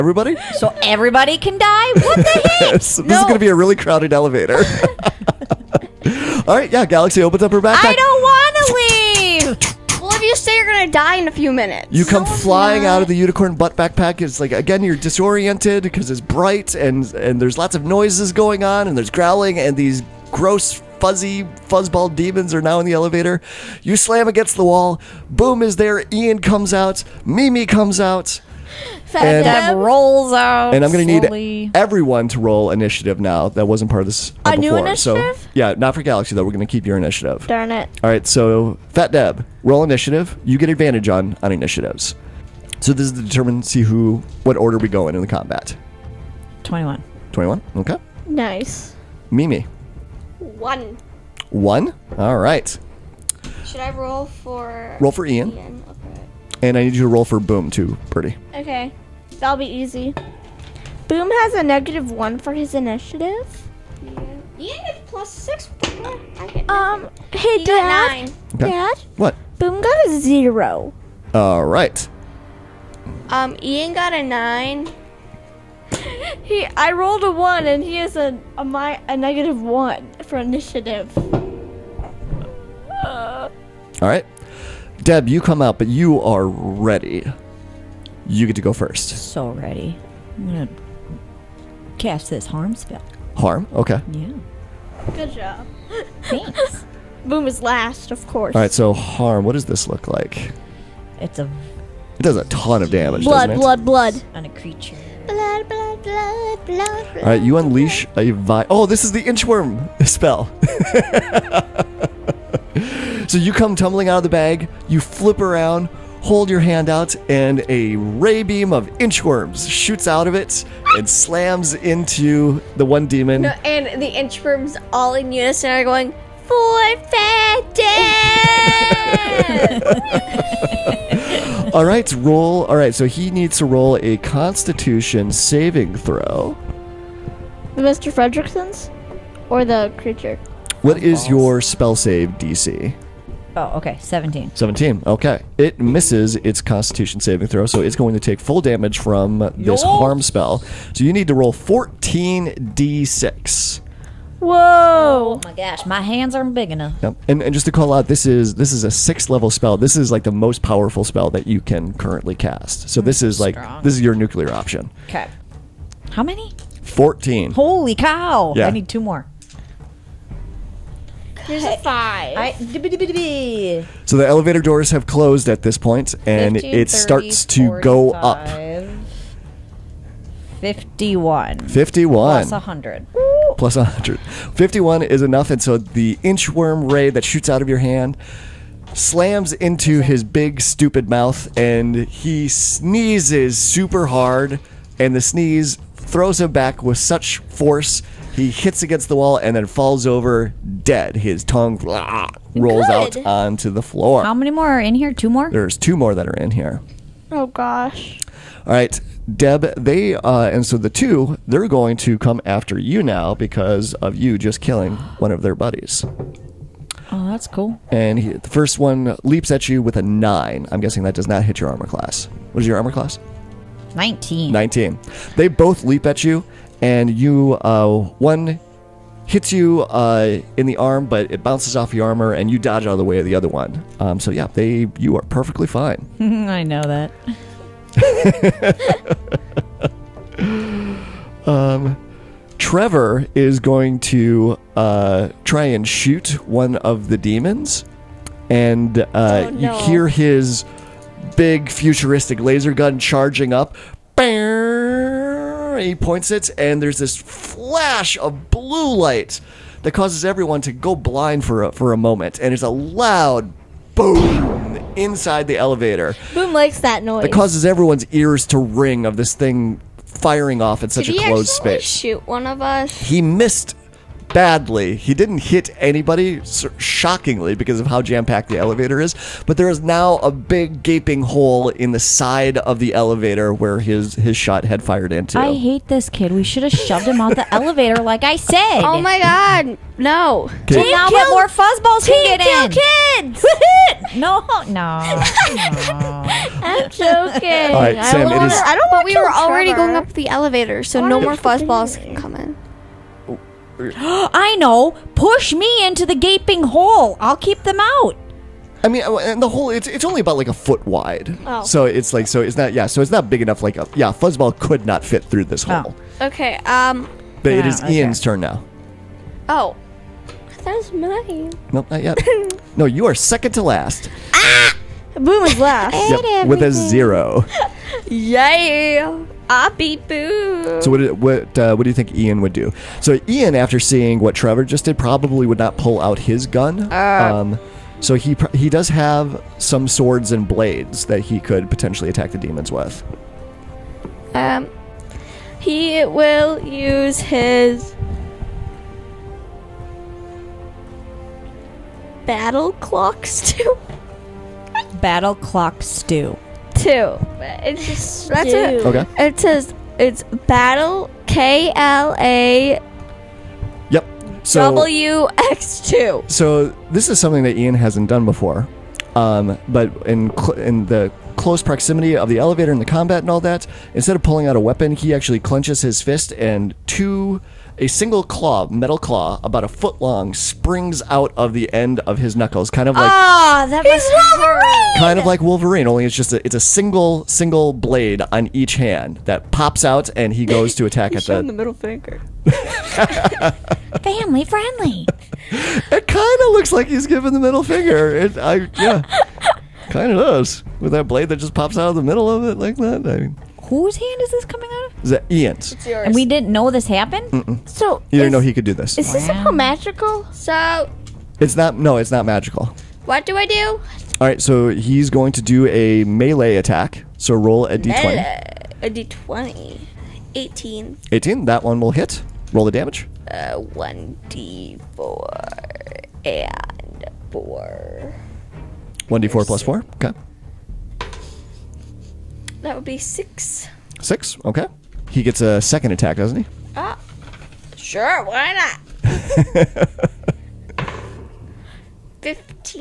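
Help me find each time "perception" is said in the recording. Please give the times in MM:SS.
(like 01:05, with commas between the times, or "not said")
not said.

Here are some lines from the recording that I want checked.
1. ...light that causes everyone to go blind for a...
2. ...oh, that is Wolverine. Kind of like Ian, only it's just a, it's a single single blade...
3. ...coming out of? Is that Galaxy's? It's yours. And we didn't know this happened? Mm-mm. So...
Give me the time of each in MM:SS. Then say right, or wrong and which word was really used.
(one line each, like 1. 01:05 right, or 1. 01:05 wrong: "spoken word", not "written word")
1. 04:18 right
2. 06:23 wrong: "Wolverine", not "Ian"
3. 06:44 wrong: "Ian", not "Galaxy".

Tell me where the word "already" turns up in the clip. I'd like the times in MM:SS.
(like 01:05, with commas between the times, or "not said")
04:59.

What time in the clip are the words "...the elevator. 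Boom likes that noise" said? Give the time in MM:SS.
04:25.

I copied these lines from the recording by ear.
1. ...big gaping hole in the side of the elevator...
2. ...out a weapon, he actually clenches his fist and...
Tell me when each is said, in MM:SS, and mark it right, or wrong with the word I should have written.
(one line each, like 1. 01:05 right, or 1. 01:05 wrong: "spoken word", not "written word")
1. 04:40 right
2. 06:14 right.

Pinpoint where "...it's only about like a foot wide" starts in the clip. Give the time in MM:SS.
05:09.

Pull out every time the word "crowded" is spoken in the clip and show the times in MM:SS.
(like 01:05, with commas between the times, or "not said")
00:03.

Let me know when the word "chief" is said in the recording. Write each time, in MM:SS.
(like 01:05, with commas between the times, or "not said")
not said.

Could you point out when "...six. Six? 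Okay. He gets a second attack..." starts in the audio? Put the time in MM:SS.
07:12.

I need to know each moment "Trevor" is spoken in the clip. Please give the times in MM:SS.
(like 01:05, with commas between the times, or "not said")
04:02, 04:59, 05:34.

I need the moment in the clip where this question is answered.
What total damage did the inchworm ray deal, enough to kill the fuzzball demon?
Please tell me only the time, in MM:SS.
03:00.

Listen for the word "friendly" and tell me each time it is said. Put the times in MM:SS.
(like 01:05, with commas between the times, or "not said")
06:34.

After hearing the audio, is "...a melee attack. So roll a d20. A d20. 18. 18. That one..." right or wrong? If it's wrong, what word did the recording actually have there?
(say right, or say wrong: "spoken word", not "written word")
right.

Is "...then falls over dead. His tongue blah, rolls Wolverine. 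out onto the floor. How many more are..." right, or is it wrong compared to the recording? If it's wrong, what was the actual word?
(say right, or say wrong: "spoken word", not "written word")
wrong: "Good", not "Wolverine".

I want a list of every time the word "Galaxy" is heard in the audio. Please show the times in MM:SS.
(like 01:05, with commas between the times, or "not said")
00:06, 00:36.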